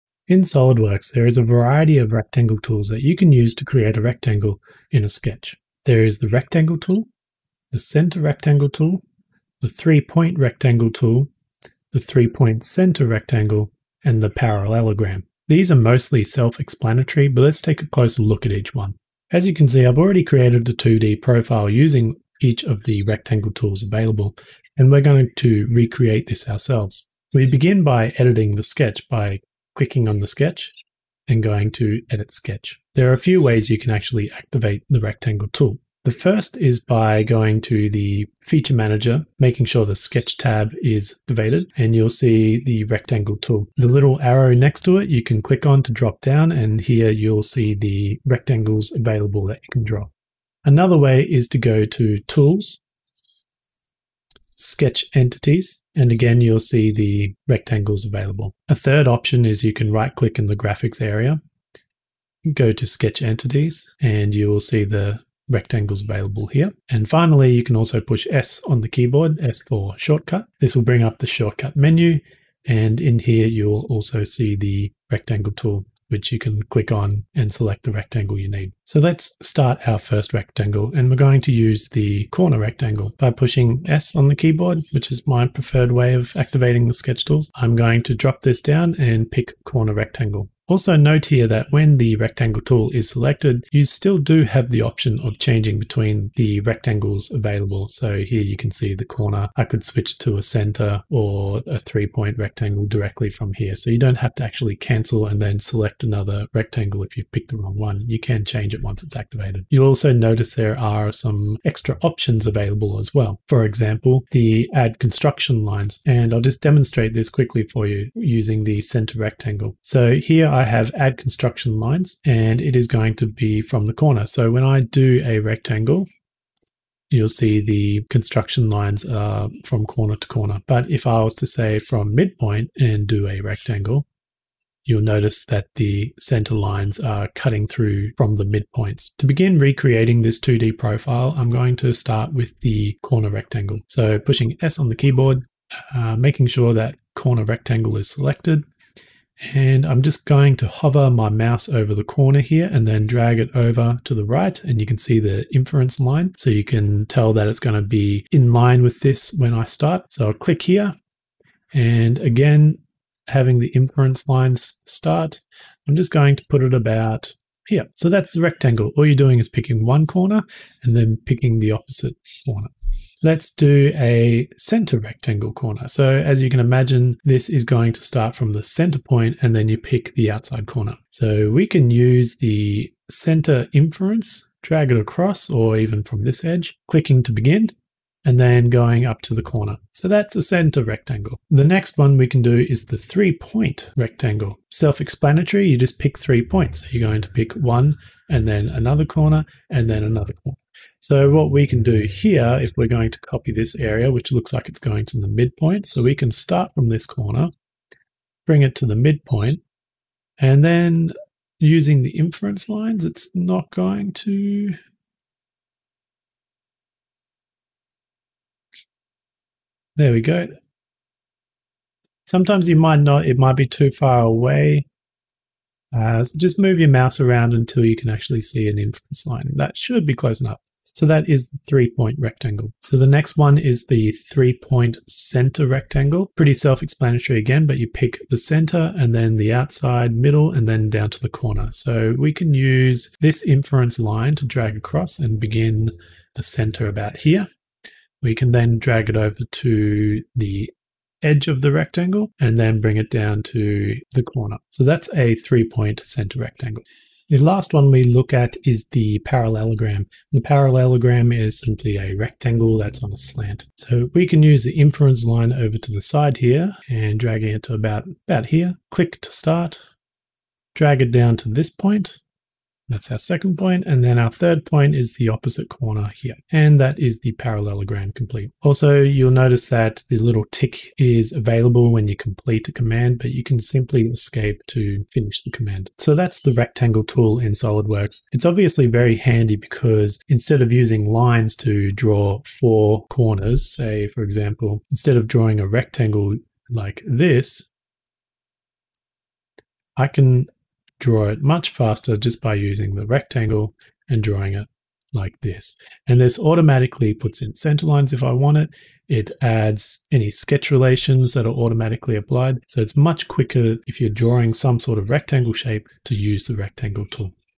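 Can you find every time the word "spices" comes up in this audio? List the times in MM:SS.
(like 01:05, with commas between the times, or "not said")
not said.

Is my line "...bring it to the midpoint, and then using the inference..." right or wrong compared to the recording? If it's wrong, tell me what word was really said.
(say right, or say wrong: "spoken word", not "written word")
right.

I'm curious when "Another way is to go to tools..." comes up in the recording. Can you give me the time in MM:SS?
00:50.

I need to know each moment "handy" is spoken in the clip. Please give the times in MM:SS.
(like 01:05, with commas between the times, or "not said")
04:49.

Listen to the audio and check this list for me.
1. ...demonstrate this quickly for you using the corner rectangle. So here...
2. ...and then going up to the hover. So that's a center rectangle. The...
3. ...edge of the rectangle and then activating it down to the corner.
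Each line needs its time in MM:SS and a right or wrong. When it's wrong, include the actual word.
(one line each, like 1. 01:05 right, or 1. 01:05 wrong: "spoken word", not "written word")
1. 01:56 wrong: "center", not "corner"
2. 03:08 wrong: "corner", not "hover"
3. 04:11 wrong: "bring", not "activating".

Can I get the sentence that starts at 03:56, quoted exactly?
Pretty self-explanatory again, but you pick the center and then the outside middle and then down to the corner.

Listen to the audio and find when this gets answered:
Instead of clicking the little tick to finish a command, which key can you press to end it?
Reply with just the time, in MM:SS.
04:44.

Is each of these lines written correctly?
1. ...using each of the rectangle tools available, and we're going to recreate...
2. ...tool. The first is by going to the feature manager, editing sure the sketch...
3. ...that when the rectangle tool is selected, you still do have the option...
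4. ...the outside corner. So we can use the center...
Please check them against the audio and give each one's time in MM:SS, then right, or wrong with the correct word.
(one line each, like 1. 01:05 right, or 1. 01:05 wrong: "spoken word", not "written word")
1. 00:21 right
2. 00:35 wrong: "making", not "editing"
3. 01:31 right
4. 03:00 right.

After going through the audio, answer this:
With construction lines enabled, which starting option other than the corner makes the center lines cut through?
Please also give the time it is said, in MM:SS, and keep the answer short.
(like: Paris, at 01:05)
From midpoint, at 02:11.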